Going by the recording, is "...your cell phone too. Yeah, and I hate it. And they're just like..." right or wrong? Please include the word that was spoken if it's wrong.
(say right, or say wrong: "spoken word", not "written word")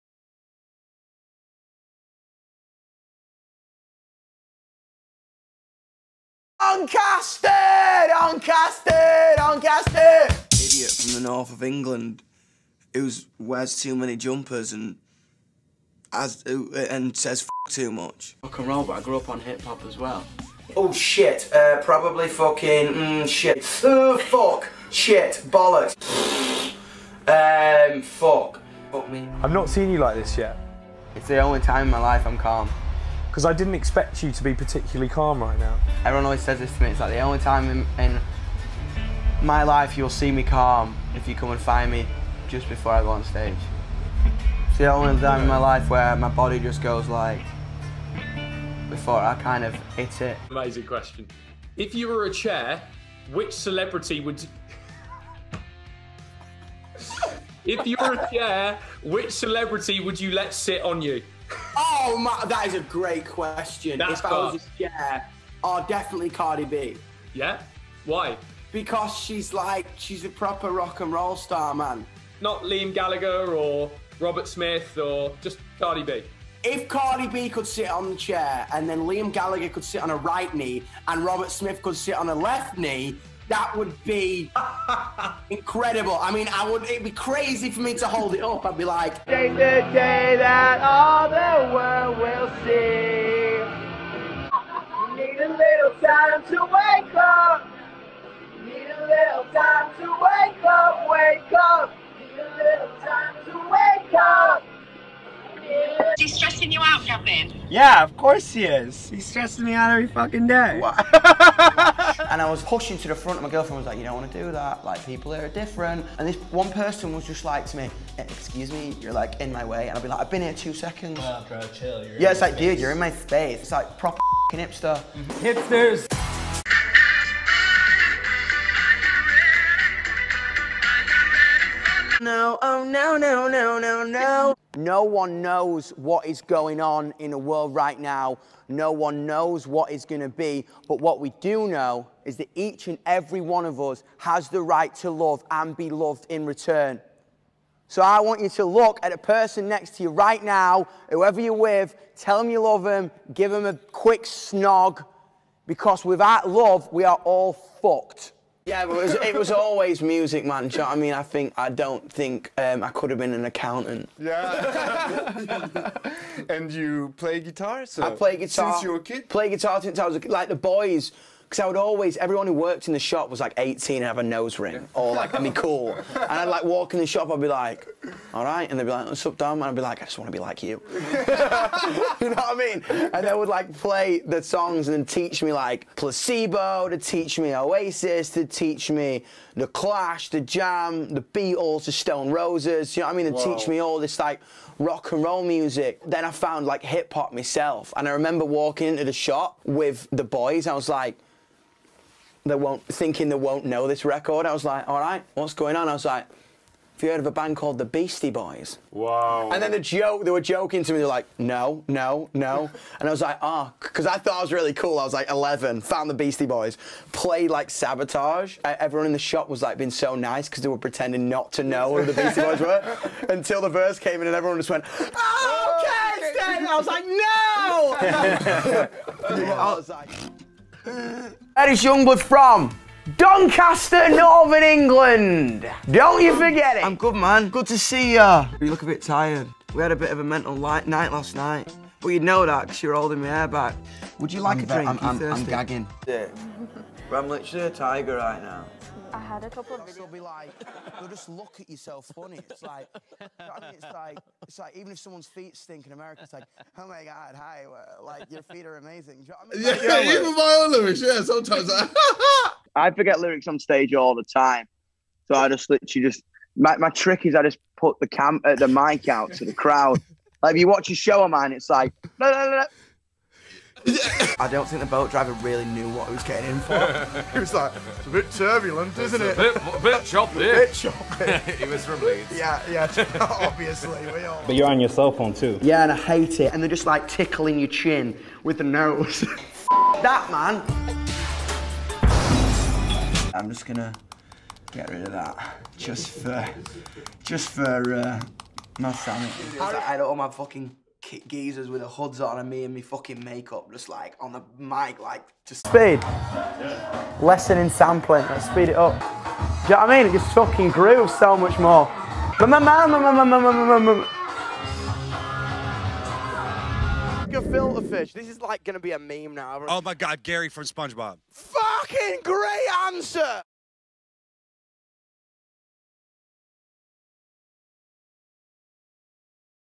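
right.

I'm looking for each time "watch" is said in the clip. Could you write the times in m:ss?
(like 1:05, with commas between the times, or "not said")
4:30.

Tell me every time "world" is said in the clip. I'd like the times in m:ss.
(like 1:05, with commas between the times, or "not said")
1:31, 2:17.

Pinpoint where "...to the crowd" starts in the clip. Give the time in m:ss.
4:29.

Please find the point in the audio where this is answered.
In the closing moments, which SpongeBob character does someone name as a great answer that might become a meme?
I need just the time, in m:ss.
5:20.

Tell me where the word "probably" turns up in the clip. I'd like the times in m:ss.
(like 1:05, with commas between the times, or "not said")
0:21.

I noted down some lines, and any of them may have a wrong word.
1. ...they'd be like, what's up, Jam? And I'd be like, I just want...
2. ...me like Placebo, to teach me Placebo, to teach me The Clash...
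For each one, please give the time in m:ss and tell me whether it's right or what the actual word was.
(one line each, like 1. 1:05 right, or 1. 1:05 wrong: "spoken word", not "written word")
1. 2:58 wrong: "Dom", not "Jam"
2. 3:05 wrong: "Oasis", not "Placebo".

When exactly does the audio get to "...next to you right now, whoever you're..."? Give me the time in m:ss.
2:29.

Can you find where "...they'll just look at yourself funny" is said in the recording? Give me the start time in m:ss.
4:10.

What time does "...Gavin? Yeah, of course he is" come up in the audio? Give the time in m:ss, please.
1:47.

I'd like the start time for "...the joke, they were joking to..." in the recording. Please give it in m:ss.
3:29.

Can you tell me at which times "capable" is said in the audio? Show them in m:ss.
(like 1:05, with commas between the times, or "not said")
not said.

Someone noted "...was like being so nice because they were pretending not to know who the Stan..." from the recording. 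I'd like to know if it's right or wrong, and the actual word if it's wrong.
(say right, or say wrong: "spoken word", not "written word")
wrong: "Beastie", not "Stan".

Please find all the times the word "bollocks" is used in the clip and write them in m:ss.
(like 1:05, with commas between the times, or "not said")
0:25.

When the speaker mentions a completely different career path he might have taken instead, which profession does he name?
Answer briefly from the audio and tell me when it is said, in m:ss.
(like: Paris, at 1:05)
accountant, at 2:43.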